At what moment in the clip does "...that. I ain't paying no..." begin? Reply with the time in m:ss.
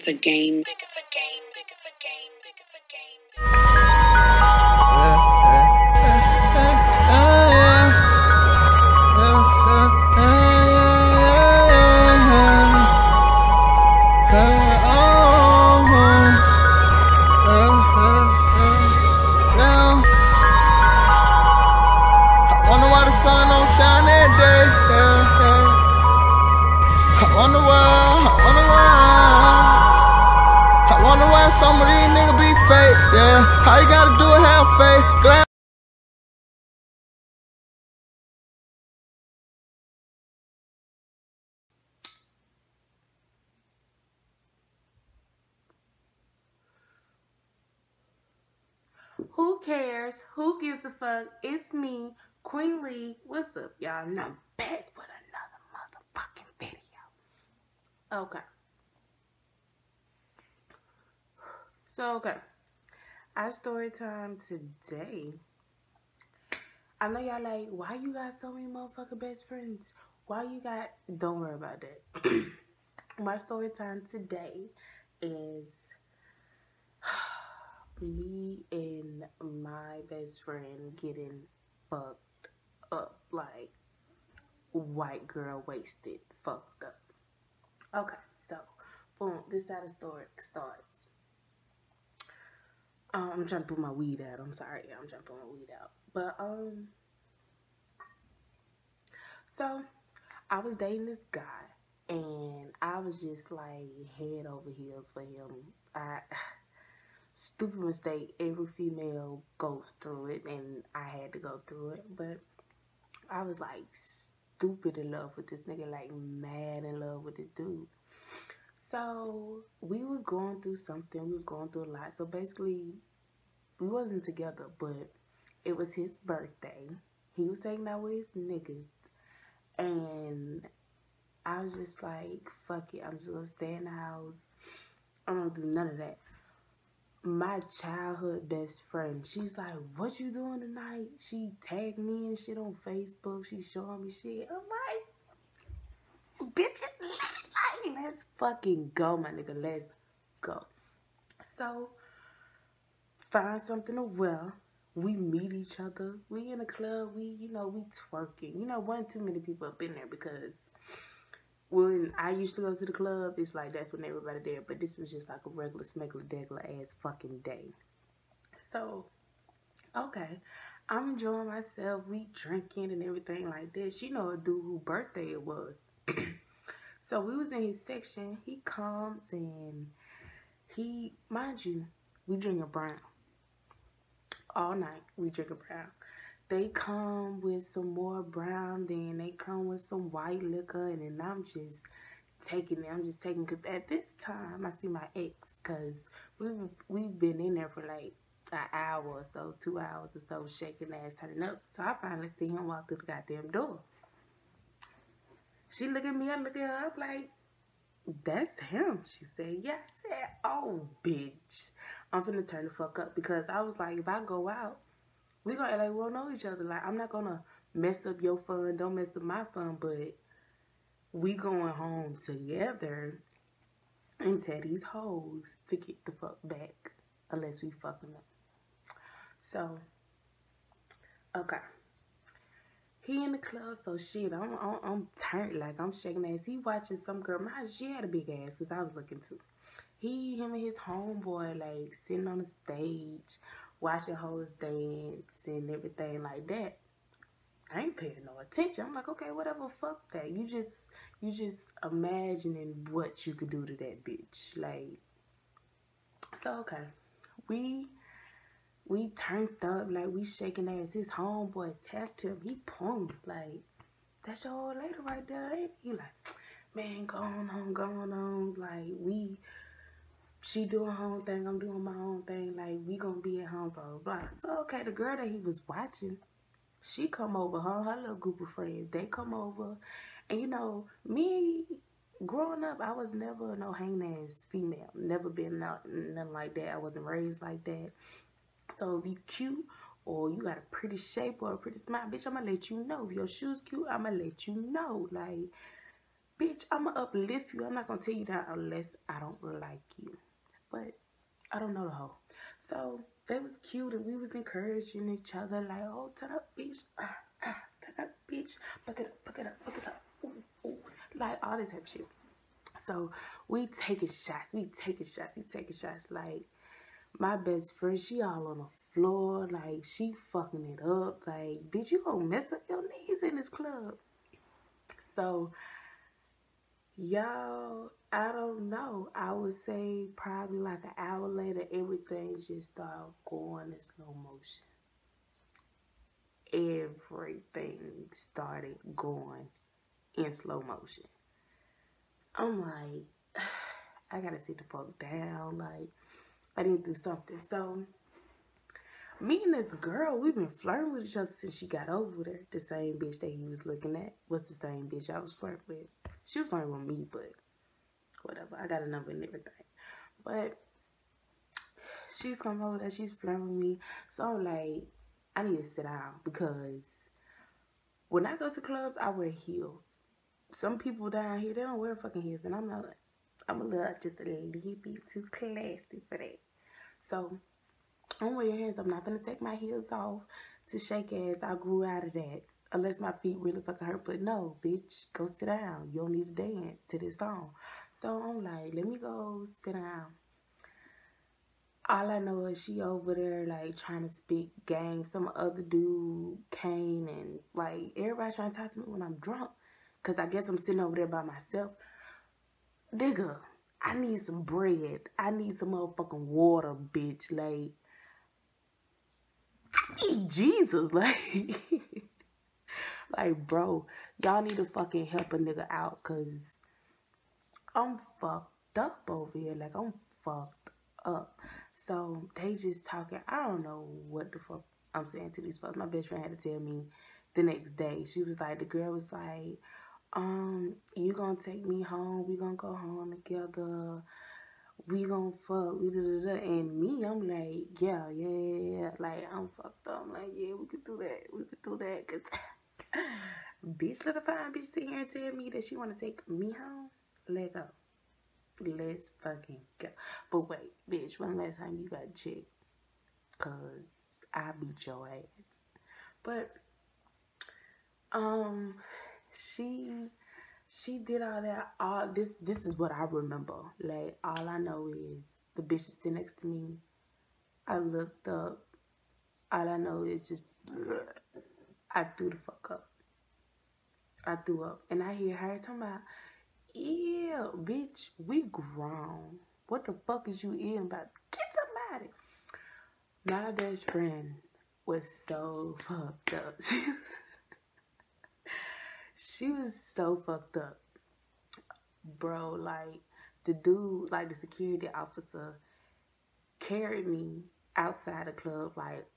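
4:06.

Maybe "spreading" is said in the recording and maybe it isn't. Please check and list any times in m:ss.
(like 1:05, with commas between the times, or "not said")
not said.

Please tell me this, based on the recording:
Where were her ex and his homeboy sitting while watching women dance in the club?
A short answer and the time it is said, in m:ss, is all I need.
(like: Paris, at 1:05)
On the stage, at 4:02.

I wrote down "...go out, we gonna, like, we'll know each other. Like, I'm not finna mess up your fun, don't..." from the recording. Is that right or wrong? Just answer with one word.
wrong.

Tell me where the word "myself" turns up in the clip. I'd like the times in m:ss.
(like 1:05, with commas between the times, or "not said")
2:51, 6:41.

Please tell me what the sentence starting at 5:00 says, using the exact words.
But I don't know the whole.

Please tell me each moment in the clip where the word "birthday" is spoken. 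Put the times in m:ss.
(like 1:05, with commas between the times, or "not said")
2:06, 2:54.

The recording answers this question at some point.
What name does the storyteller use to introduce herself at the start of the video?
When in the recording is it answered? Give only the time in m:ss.
0:52.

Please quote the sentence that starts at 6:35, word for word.
Some other dude came and like everybody trying to talk to me when I'm drunk.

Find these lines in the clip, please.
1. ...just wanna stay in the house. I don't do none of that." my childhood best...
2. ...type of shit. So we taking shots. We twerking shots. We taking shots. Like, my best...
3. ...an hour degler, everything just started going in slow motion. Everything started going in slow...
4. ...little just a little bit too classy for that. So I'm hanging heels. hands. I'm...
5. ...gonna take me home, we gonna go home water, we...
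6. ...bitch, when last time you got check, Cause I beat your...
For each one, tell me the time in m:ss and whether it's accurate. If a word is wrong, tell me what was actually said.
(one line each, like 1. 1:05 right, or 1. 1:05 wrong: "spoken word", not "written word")
1. 2:13 wrong: "gonna", not "wanna"
2. 5:11 wrong: "taking", not "twerking"
3. 5:30 wrong: "later", not "degler"
4. 6:13 wrong: "wearing", not "hanging"
5. 7:11 wrong: "together", not "water"
6. 7:30 right.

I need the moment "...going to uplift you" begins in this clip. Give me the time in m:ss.
4:56.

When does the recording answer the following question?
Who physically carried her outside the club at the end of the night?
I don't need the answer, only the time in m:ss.
8:14.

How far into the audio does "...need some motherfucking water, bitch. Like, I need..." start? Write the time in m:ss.
6:45.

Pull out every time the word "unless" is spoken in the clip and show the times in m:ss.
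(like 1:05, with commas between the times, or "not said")
3:47, 4:58, 6:22.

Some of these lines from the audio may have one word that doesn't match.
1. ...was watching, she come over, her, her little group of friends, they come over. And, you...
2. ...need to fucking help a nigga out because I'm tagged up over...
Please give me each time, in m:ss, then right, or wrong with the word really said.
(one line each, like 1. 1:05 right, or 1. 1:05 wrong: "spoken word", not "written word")
1. 4:35 right
2. 6:54 wrong: "fucked", not "tagged".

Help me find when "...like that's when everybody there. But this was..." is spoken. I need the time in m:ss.
2:43.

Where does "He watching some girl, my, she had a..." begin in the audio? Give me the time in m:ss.
3:56.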